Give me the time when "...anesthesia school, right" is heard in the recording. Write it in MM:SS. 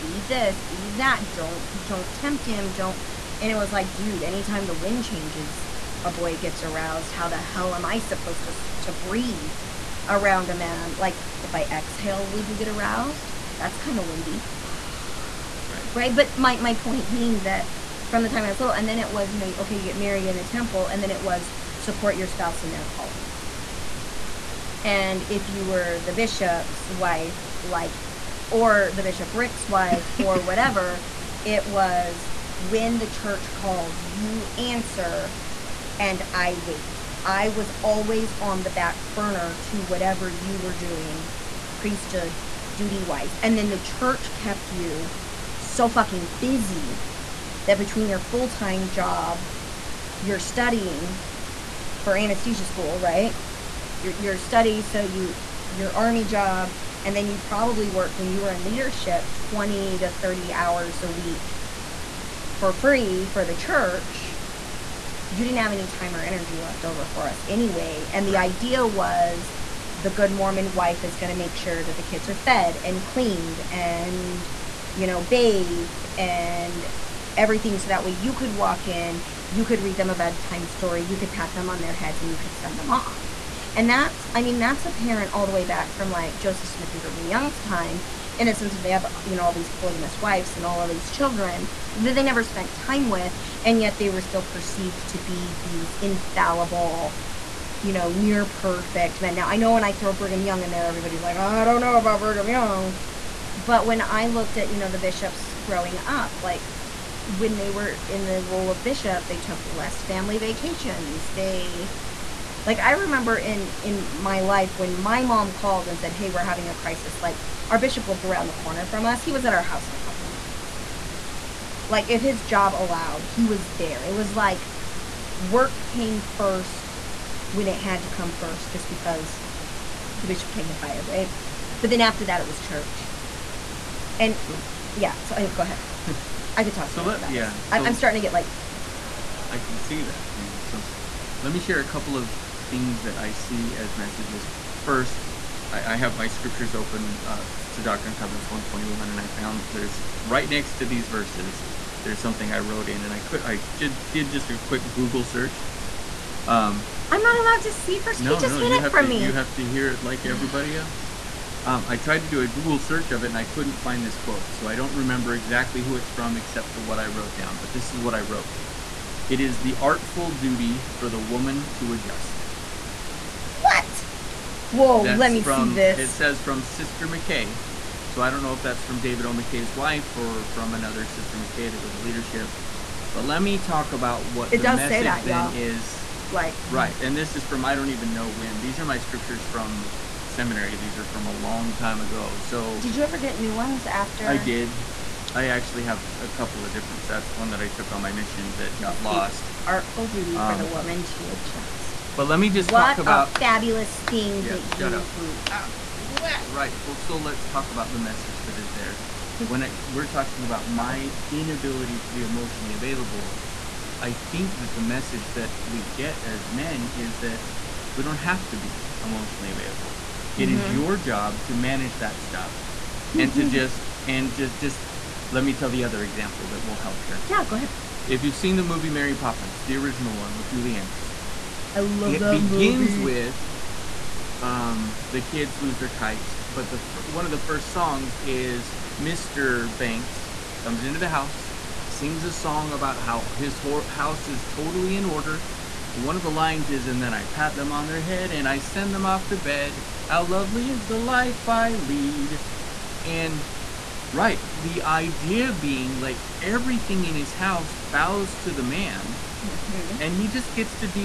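00:52.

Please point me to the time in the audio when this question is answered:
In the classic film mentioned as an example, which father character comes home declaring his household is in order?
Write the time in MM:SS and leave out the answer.
03:58.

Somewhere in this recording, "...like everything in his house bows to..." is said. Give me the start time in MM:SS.
04:15.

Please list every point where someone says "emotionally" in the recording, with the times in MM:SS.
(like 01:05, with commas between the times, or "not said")
03:32, 03:39.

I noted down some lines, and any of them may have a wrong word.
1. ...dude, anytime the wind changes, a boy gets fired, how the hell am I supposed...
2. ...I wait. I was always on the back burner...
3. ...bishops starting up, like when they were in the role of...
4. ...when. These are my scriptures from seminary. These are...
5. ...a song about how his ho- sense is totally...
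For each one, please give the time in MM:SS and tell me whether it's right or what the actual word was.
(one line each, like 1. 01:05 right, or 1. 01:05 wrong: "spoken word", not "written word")
1. 00:03 wrong: "aroused", not "fired"
2. 00:36 right
3. 01:44 wrong: "growing", not "starting"
4. 03:08 right
5. 04:02 wrong: "house", not "sense".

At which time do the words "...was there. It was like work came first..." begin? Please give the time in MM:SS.
02:03.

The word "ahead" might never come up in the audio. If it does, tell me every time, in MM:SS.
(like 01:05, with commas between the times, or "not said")
02:15, 03:47.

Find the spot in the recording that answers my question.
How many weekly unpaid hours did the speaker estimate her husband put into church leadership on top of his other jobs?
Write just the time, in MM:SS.
00:59.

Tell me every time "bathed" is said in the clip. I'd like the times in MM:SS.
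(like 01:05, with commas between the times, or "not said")
01:15.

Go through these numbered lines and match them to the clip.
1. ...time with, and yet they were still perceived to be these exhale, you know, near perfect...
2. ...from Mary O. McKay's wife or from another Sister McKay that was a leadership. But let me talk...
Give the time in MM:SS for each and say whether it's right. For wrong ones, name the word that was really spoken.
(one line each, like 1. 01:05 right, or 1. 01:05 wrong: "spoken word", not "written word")
1. 01:32 wrong: "infallible", not "exhale"
2. 02:58 wrong: "David", not "Mary".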